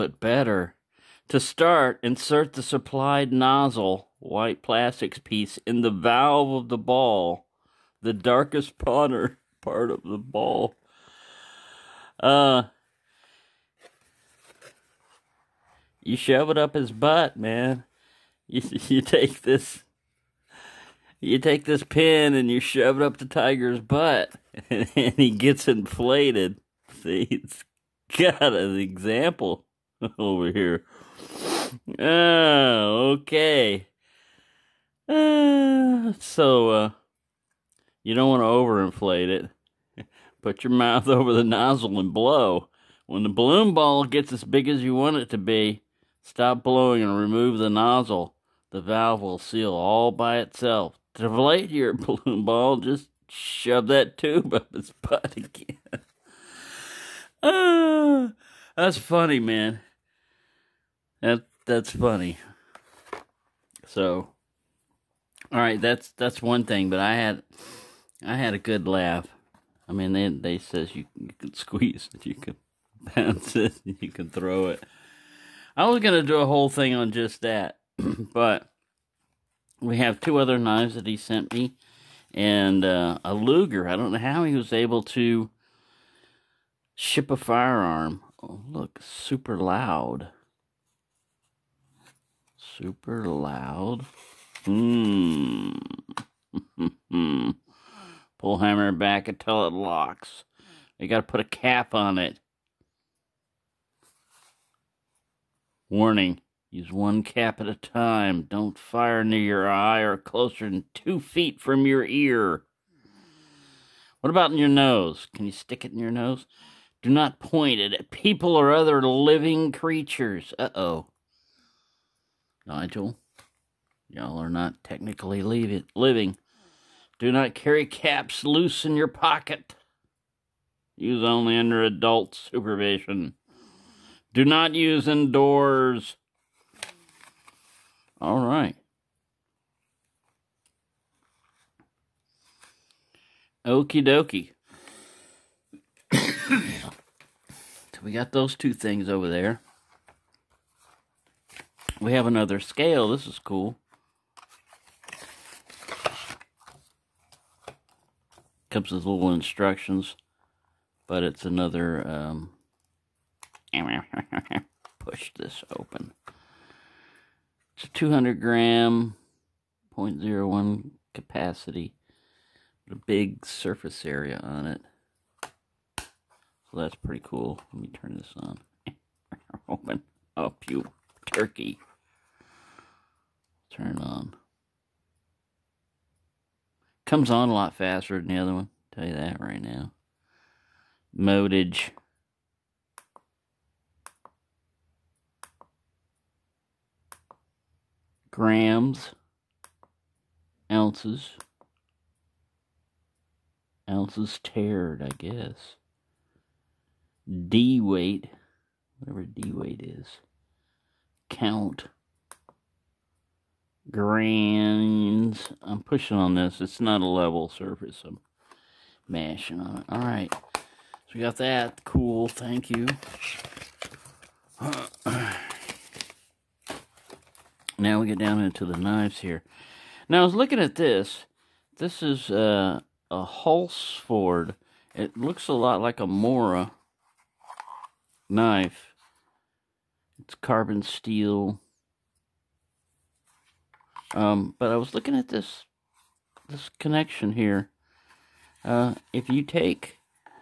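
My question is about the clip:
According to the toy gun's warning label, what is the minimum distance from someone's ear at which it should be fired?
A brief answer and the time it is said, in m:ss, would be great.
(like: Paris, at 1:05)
2 feet, at 1:50.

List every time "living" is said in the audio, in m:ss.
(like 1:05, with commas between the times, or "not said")
1:59, 2:05.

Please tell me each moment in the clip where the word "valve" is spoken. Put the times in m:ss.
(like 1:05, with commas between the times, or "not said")
0:05, 0:48.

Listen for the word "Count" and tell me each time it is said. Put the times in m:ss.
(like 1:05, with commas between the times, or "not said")
3:31.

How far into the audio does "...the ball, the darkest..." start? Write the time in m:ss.
0:06.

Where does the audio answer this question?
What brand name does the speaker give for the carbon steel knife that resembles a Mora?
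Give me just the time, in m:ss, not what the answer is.
3:53.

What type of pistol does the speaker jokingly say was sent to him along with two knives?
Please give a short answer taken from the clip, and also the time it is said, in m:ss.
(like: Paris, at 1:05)
Luger, at 1:23.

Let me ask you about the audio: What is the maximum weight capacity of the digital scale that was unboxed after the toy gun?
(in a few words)
200 grams.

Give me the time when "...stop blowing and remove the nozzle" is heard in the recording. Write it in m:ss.
0:46.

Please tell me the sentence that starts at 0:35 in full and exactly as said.
Uh, so, uh, you don't want to overinflate it.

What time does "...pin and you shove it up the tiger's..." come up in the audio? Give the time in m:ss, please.
0:21.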